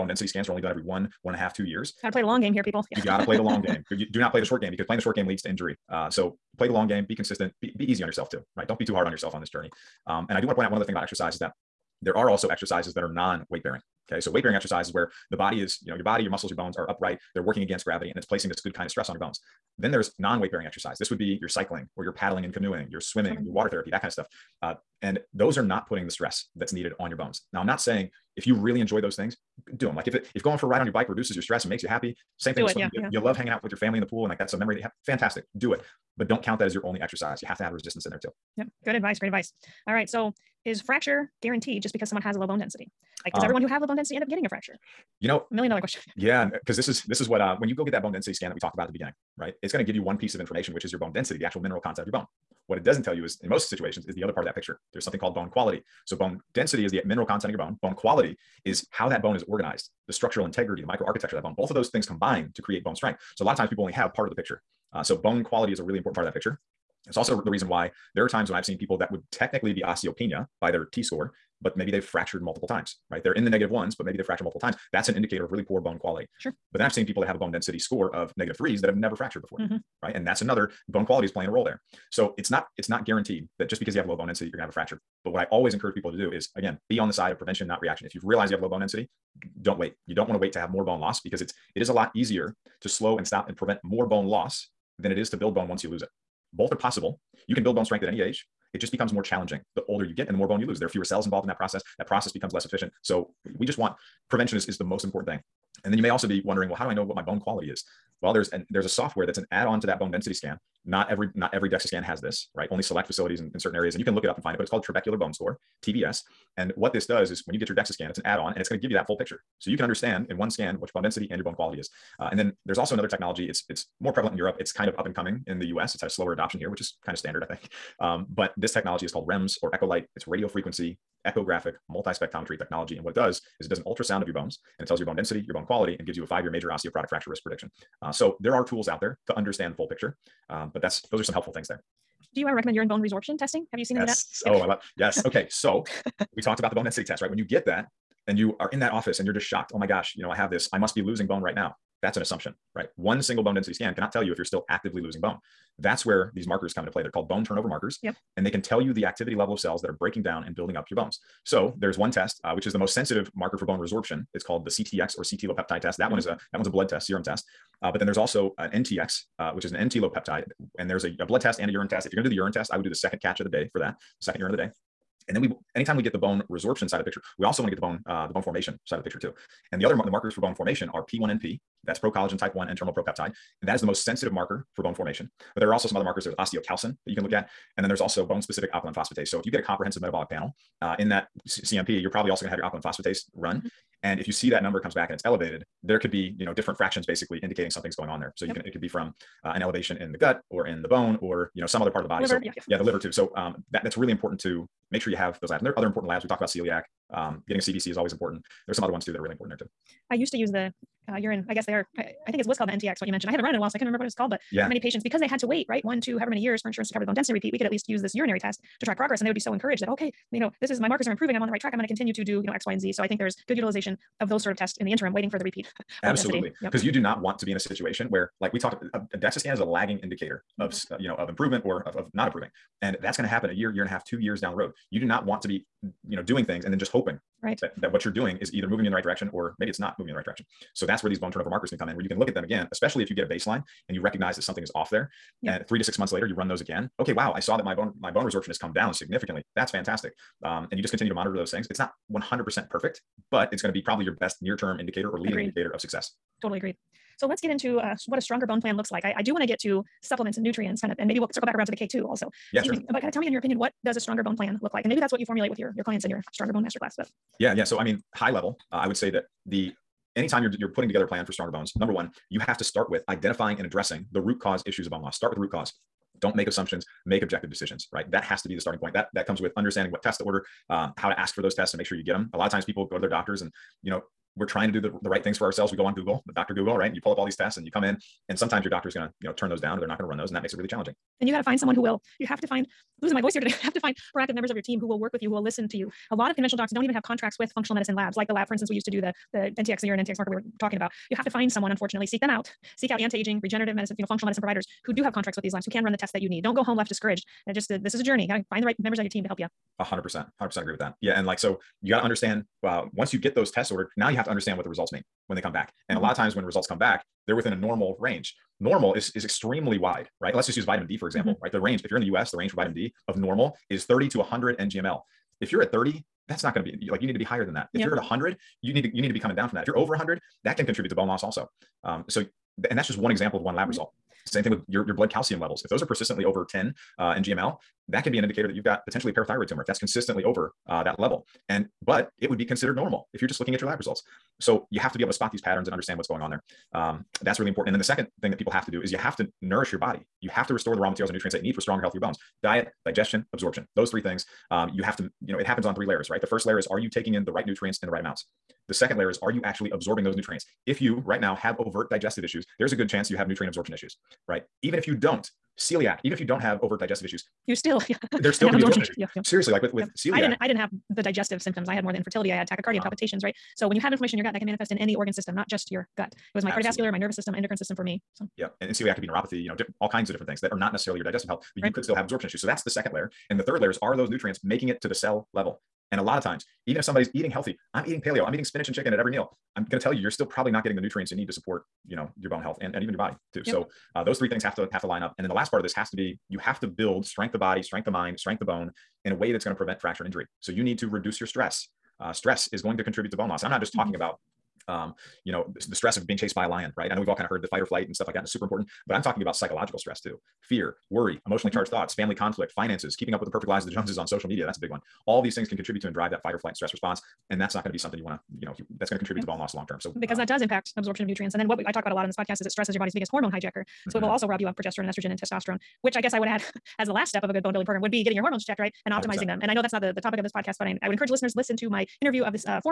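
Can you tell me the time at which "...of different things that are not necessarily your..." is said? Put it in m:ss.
6:20.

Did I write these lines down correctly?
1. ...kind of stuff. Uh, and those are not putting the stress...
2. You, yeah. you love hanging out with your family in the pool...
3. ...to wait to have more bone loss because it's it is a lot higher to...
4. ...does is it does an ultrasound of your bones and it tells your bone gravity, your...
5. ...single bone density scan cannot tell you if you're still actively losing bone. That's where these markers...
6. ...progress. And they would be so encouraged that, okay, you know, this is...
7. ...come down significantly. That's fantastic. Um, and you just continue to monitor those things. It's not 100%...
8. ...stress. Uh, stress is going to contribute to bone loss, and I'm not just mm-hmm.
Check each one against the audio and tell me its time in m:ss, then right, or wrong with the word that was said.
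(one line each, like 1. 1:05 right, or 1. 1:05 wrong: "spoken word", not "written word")
1. 0:24 right
2. 0:32 right
3. 1:30 wrong: "easier", not "higher"
4. 2:13 wrong: "density", not "gravity"
5. 2:33 right
6. 3:38 right
7. 4:08 right
8. 6:41 right.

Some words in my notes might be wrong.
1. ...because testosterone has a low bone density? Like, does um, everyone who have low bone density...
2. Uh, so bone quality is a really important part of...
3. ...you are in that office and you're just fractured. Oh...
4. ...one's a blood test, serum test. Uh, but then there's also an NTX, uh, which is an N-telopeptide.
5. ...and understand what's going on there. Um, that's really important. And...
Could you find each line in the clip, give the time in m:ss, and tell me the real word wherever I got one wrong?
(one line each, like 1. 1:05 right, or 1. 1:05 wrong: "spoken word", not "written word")
1. 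0:41 wrong: "someone", not "testosterone"
2. 1:04 right
3. 2:28 wrong: "shocked", not "fractured"
4. 2:46 right
5. 5:45 right.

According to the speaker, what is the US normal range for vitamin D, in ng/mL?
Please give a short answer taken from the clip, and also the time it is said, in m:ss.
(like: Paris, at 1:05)
30 to 100, at 5:23.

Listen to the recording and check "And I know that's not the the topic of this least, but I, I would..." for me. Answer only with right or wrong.
wrong.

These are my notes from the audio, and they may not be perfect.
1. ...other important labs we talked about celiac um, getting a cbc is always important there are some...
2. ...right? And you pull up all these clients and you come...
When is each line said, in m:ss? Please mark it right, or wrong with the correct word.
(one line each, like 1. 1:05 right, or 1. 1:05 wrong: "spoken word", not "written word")
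1. 3:25 right
2. 4:46 wrong: "tests", not "clients".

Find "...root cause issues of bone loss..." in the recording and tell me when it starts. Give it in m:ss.
4:34.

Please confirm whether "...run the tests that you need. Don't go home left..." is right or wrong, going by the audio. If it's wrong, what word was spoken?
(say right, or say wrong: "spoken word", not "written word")
right.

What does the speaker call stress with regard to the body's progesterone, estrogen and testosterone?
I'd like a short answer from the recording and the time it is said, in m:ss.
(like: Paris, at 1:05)
Biggest hormone hijacker, at 7:02.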